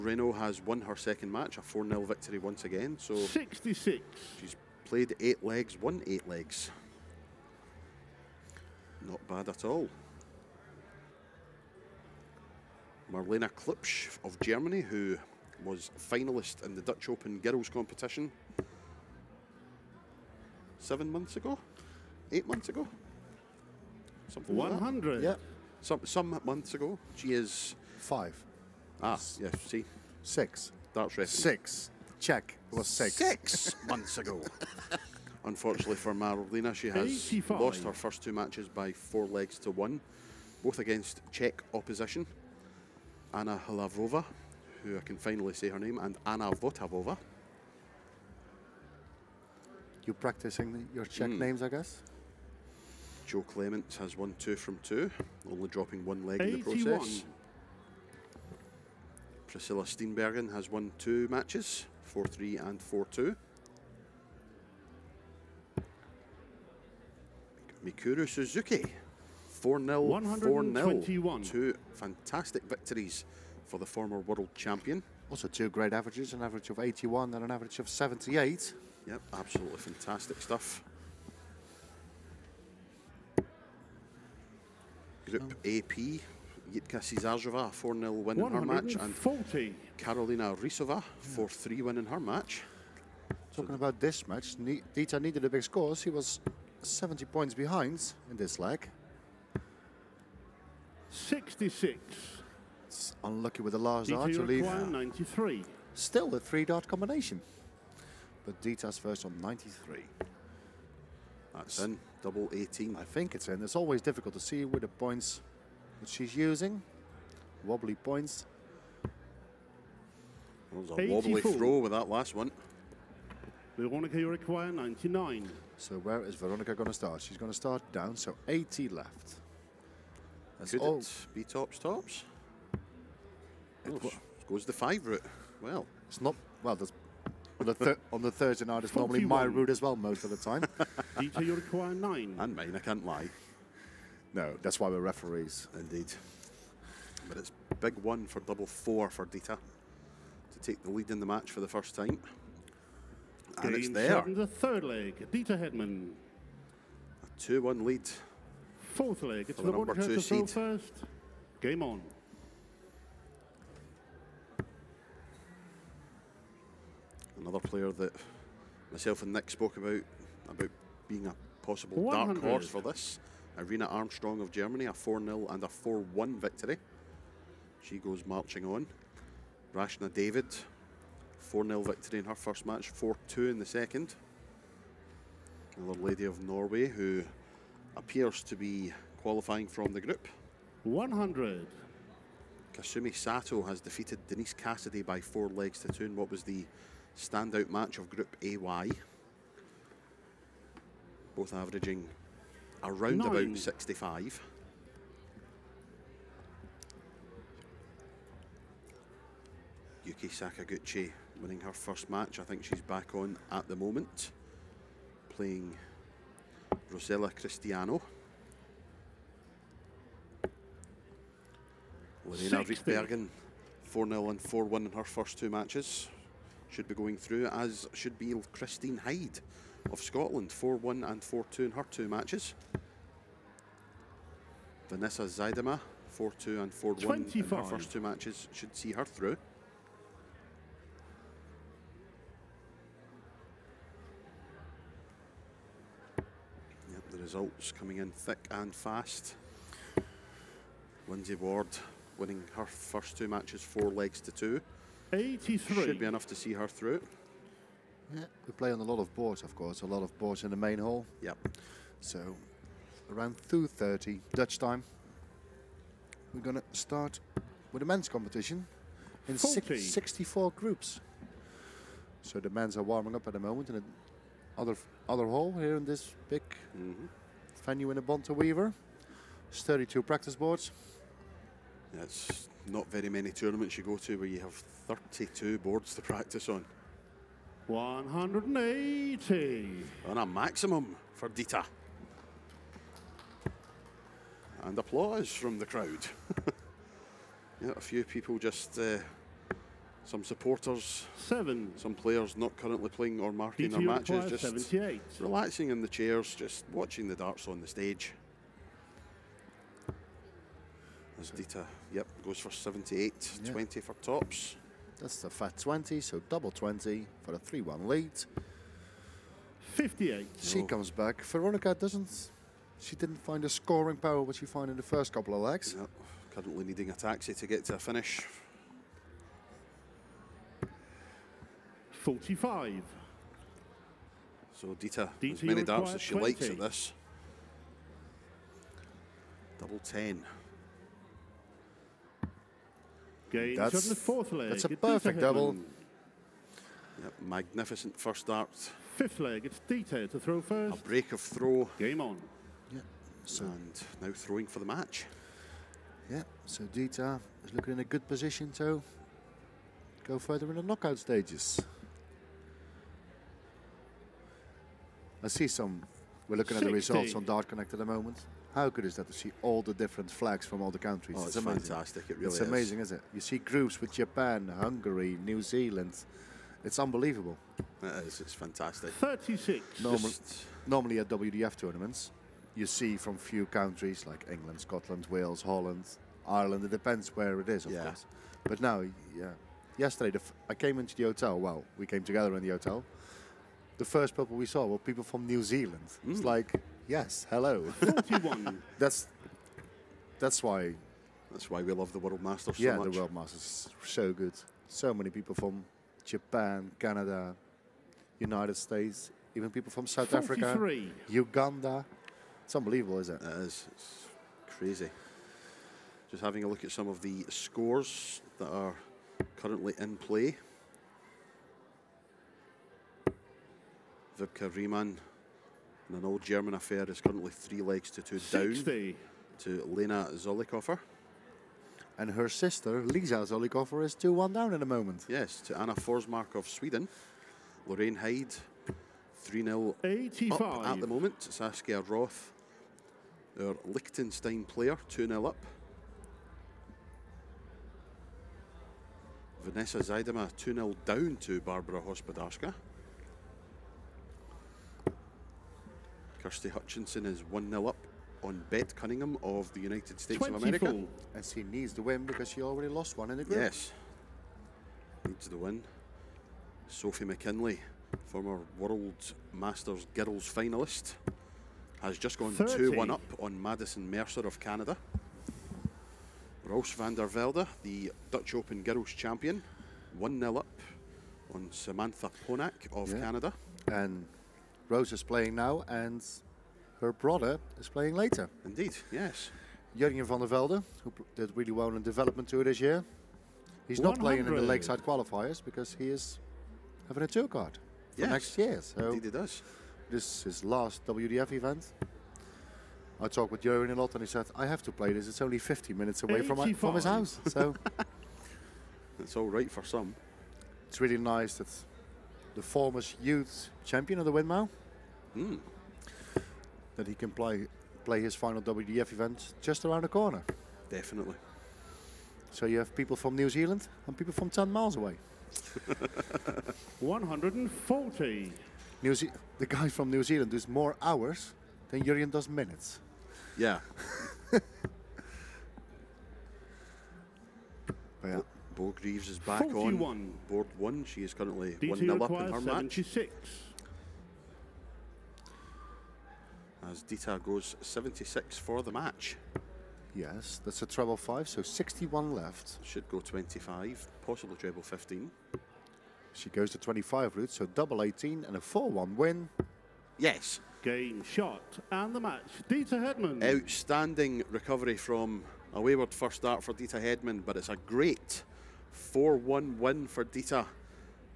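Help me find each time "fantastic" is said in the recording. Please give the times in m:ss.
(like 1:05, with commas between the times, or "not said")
1:11, 1:19, 6:11, 6:18.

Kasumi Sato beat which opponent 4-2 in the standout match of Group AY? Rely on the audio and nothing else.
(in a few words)
Denise Cassidy.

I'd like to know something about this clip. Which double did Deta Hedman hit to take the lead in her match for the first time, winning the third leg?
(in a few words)
double 4.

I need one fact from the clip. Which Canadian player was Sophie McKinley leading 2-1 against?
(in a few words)
Madison Mercer.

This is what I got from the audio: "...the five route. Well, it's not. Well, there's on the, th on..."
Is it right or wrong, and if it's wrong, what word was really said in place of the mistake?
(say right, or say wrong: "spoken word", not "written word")
right.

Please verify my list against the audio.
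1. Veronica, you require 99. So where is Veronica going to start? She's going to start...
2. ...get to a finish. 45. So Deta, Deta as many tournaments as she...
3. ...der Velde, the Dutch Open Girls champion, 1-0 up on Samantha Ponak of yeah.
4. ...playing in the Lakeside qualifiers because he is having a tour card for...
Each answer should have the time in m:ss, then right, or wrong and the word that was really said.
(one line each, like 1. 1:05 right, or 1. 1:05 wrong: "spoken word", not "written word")
1. 2:03 right
2. 5:27 wrong: "darts", not "tournaments"
3. 7:56 right
4. 8:14 right.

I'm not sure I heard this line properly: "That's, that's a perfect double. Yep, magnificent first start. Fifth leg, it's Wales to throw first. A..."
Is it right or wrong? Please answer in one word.
wrong.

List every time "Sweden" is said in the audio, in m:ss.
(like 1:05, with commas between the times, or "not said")
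7:16.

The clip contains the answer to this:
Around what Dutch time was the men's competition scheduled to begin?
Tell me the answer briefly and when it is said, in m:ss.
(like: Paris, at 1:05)
2:30, at 4:23.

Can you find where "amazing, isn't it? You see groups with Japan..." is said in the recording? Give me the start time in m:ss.
6:12.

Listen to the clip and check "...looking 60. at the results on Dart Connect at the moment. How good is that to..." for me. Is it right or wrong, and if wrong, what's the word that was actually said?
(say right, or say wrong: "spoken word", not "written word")
right.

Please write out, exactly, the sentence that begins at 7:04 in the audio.
Vibka Riemann in an old German affair is currently three legs to two 60.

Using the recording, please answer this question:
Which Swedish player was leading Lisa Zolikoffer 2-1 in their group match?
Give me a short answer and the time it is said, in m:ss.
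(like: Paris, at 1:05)
Anna Forsmark, at 7:15.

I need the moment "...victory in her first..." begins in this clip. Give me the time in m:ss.
3:01.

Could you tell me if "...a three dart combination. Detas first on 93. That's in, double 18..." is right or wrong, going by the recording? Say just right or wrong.
right.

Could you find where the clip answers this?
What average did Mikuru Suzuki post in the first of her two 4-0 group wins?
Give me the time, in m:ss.
1:16.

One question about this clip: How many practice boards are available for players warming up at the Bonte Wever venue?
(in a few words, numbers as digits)
32.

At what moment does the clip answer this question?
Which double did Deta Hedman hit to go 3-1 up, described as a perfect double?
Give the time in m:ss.
5:39.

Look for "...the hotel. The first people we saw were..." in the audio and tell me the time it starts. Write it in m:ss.
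6:32.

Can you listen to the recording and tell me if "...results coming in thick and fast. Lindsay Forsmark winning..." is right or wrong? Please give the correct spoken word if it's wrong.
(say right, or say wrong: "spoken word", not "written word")
wrong: "Ward", not "Forsmark".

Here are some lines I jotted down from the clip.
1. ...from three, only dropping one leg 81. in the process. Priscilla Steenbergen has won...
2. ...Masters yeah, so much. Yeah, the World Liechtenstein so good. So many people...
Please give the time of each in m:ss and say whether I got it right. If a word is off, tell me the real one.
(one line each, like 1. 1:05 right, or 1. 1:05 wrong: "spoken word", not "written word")
1. 0:54 wrong: "two", not "three"
2. 6:42 wrong: "Masters", not "Liechtenstein".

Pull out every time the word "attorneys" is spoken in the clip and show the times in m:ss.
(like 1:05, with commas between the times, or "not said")
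not said.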